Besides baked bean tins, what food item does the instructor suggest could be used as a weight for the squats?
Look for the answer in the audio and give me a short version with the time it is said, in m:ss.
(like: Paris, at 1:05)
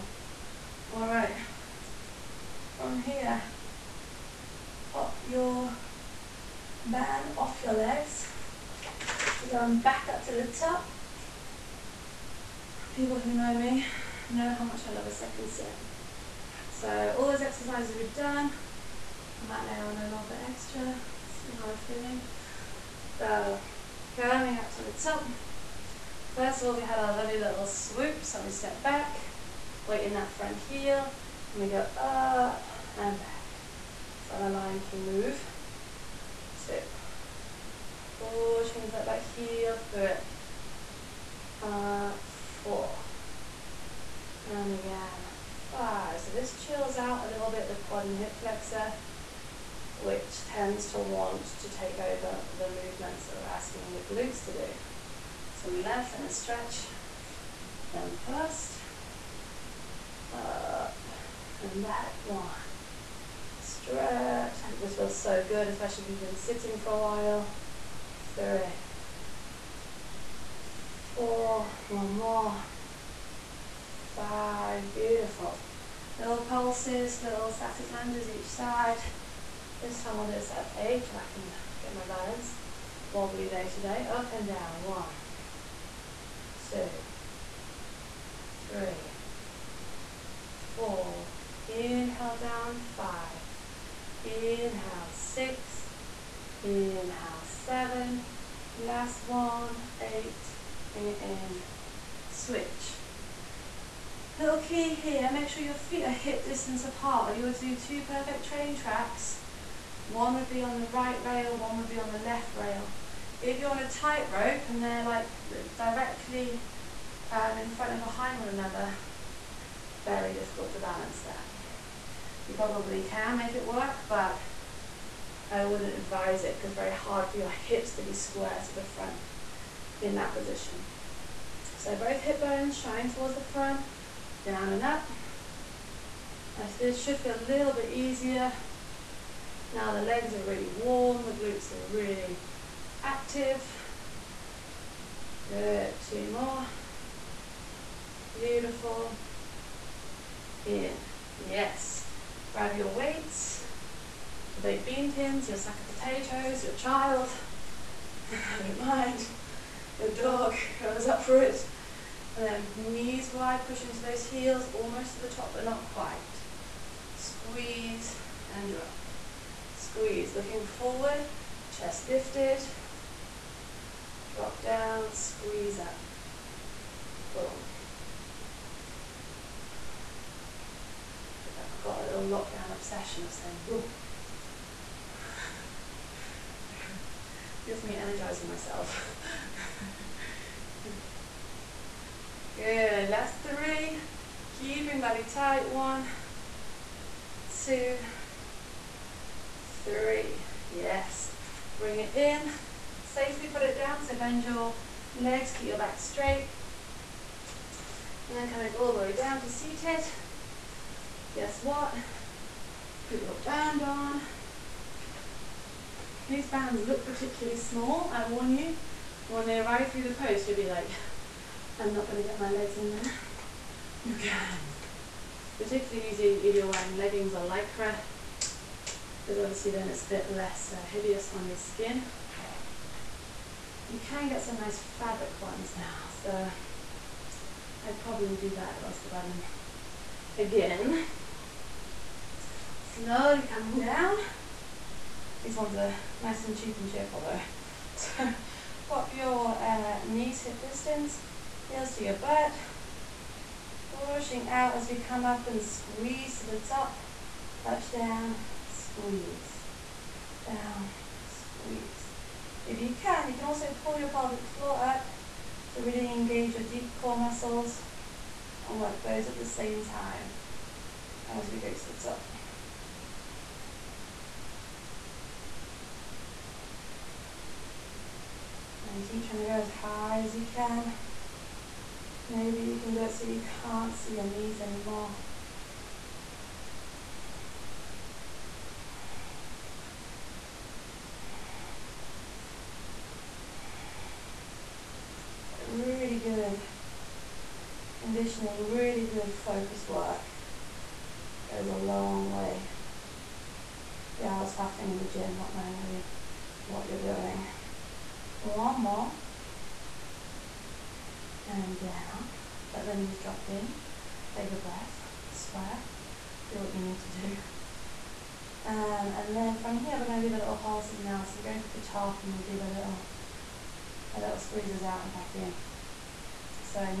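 sack of potatoes, at 2:35.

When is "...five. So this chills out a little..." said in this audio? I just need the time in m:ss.
0:45.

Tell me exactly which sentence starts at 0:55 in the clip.
So we left and stretch them first back one.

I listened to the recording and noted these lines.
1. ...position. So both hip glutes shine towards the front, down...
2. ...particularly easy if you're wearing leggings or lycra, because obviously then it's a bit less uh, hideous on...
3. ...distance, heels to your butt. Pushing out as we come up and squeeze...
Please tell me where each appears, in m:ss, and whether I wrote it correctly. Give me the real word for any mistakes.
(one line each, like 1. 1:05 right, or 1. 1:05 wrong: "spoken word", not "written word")
1. 2:10 wrong: "bones", not "glutes"
2. 3:45 right
3. 4:10 right.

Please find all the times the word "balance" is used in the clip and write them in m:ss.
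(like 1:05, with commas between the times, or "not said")
1:22, 2:00.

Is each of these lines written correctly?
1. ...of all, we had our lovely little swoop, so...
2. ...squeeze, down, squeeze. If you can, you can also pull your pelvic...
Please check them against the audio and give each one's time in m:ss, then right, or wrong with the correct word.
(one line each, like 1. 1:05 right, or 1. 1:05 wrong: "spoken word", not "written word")
1. 0:26 right
2. 4:18 right.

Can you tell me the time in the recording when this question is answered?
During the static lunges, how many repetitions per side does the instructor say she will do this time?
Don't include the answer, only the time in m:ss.
1:20.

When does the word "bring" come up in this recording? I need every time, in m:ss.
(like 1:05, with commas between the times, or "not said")
1:40, 3:21.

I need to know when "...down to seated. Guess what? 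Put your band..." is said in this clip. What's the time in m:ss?
3:29.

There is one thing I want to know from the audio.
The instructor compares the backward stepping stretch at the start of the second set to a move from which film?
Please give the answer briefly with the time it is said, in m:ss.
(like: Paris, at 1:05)
Lion King, at 0:34.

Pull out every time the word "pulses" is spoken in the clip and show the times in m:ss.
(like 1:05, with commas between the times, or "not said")
1:16, 5:20.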